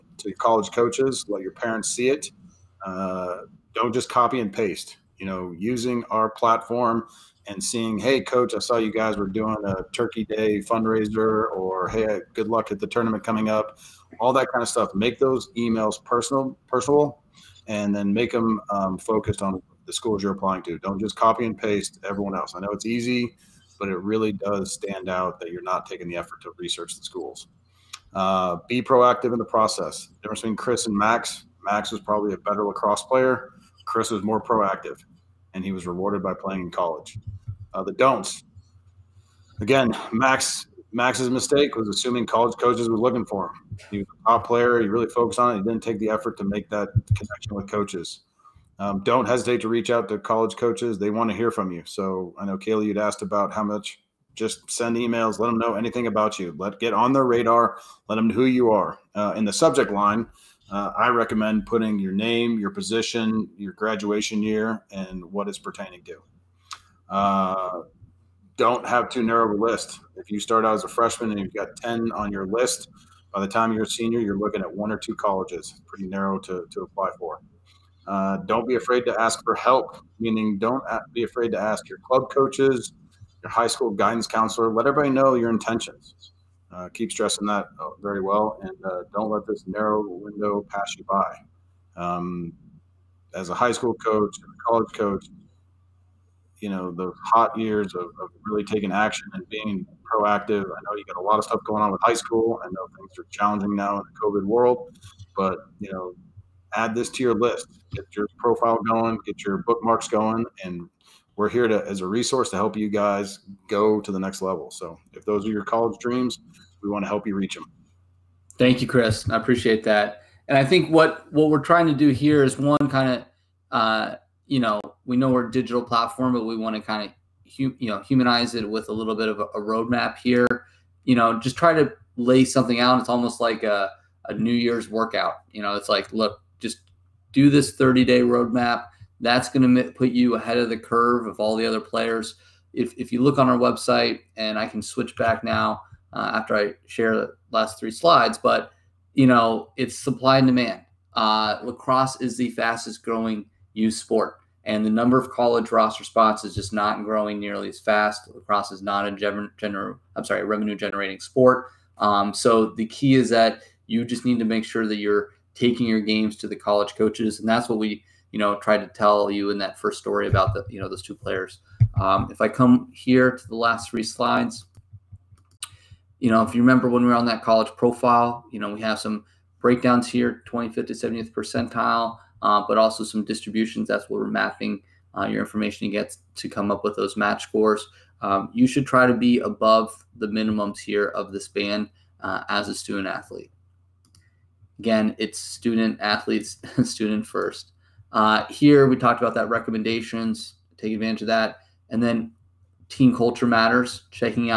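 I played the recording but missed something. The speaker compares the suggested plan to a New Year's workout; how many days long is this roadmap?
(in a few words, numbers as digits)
30 days.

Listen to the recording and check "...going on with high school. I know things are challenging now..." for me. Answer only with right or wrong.
right.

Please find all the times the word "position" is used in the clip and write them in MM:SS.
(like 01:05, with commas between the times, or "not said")
01:02.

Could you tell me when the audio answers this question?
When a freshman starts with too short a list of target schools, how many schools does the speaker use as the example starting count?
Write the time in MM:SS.
01:11.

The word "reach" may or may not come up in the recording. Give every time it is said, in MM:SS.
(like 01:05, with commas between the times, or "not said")
00:49, 01:57.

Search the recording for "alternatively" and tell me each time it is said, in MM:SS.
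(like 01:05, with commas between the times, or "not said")
not said.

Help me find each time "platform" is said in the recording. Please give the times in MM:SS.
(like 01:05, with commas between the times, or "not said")
00:06, 02:05.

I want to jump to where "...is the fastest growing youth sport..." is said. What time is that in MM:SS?
02:32.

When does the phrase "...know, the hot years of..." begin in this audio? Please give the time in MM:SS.
01:36.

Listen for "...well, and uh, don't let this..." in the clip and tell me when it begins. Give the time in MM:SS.
01:28.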